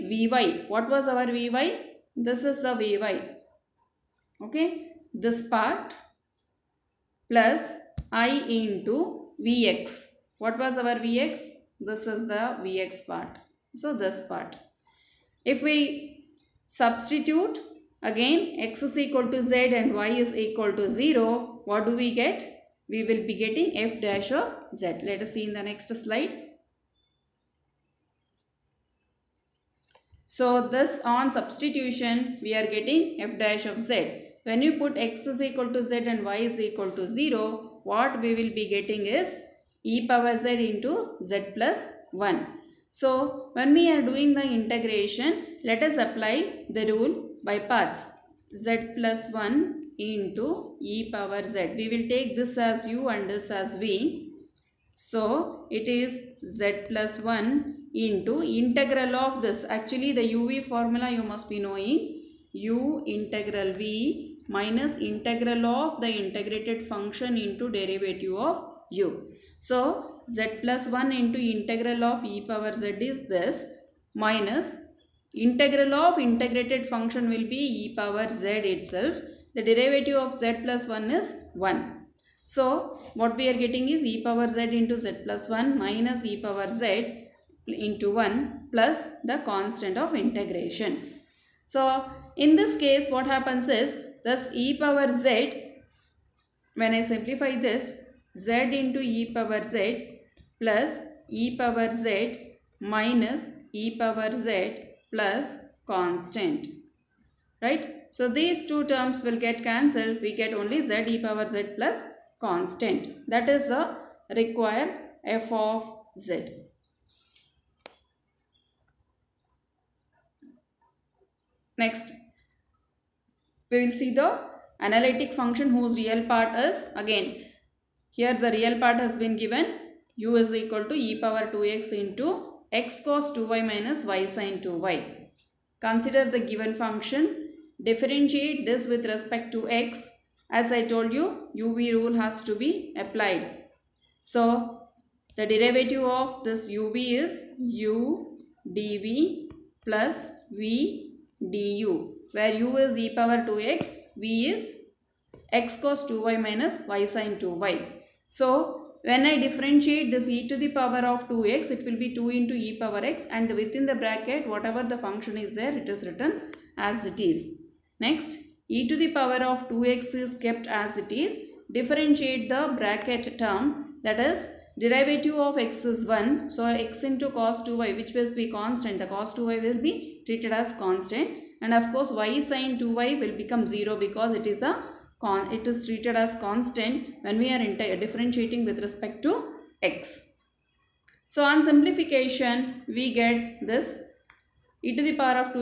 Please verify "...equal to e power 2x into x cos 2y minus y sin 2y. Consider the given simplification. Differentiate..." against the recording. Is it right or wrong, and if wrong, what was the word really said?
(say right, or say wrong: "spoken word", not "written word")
wrong: "function", not "simplification".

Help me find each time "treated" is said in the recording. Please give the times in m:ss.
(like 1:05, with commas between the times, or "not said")
3:00, 3:05.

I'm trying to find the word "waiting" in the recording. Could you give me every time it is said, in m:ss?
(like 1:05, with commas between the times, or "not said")
not said.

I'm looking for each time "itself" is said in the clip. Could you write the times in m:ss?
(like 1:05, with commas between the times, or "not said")
1:18.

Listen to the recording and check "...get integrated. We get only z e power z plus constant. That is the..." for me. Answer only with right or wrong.
wrong.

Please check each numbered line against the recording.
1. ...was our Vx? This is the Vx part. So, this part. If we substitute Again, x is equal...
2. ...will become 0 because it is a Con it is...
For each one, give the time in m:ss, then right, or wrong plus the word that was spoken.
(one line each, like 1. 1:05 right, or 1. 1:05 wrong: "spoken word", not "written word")
1. 0:10 right
2. 3:03 right.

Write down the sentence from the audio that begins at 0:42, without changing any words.
So when we are doing the integration, let us apply the rule by parts z plus 1 into e power z.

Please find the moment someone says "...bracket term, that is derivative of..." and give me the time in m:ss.
2:52.